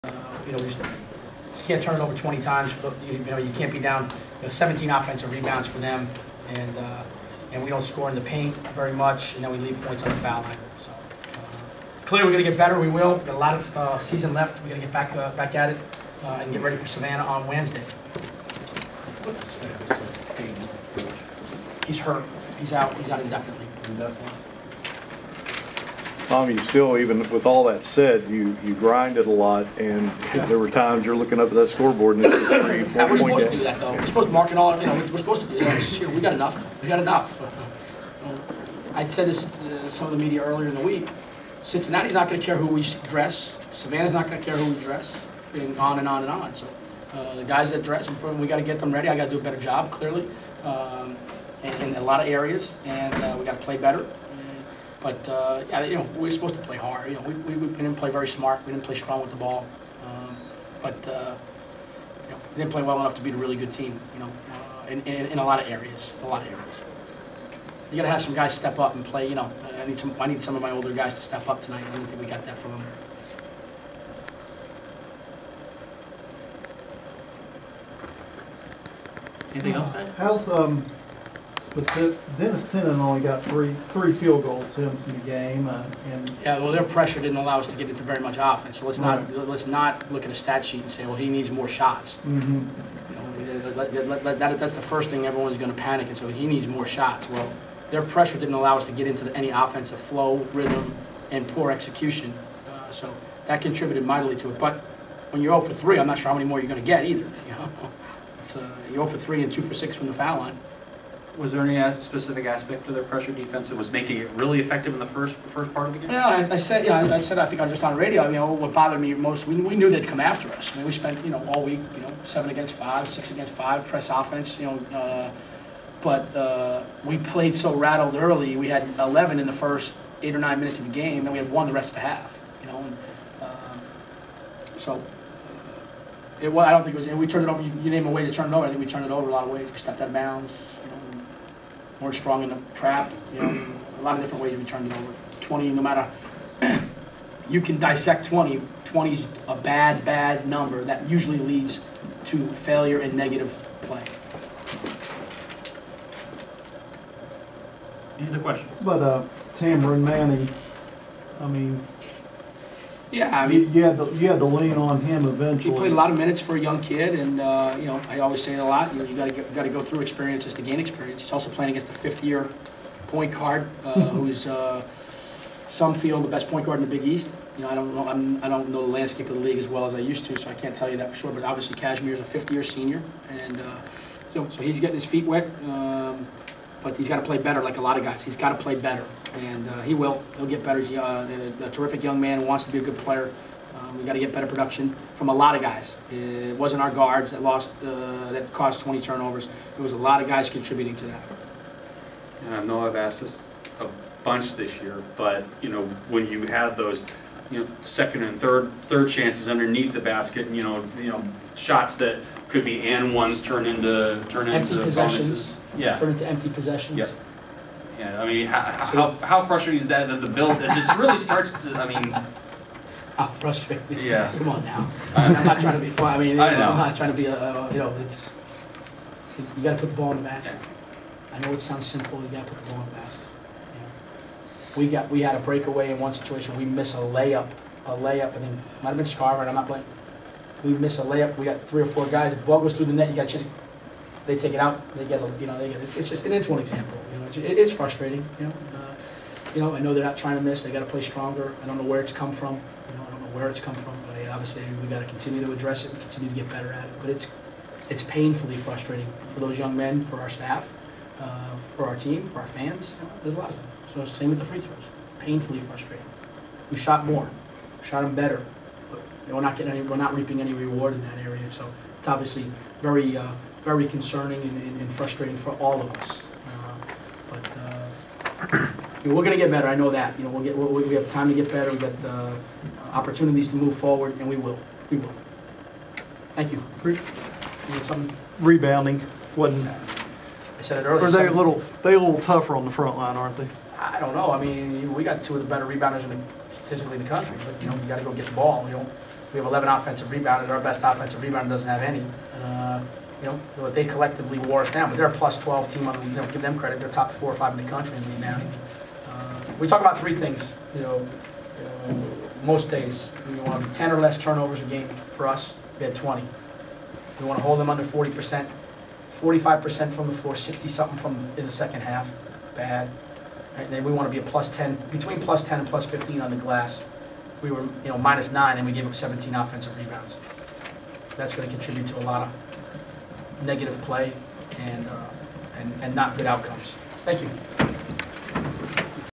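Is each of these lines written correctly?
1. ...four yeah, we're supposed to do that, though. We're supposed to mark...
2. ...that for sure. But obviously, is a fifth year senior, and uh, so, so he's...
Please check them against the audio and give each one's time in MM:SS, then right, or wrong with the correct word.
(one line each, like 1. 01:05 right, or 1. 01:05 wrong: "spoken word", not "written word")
1. 00:32 right
2. 03:00 right.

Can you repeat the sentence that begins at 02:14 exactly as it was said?
Uh, it, well, I don't think it was.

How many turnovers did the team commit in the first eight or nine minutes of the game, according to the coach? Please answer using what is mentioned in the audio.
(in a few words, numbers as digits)
11.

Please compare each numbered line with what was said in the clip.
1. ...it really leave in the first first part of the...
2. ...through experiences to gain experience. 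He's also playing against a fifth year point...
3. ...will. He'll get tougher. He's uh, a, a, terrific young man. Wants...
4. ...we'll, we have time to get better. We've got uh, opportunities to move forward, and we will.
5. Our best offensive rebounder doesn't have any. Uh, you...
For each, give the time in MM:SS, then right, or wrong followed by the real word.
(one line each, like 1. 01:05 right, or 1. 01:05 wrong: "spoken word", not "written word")
1. 01:54 wrong: "effective", not "leave"
2. 02:49 right
3. 03:09 wrong: "better", not "tougher"
4. 04:40 right
5. 05:00 right.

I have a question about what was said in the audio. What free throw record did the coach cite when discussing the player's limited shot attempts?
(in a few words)
2 for 6.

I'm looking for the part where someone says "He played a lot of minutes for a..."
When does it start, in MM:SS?
02:45.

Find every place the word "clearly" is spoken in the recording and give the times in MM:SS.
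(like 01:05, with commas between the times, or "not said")
00:12, 00:49.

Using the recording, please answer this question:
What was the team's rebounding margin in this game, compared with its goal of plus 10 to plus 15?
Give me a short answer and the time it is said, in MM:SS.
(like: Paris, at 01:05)
minus 9, at 05:27.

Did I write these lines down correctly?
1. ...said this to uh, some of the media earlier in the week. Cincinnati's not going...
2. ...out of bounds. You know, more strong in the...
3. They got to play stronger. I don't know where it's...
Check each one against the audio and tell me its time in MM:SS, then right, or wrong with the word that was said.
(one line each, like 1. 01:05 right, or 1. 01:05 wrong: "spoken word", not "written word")
1. 00:39 right
2. 02:20 right
3. 04:10 right.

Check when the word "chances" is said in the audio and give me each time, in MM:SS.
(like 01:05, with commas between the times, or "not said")
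03:29, 04:03.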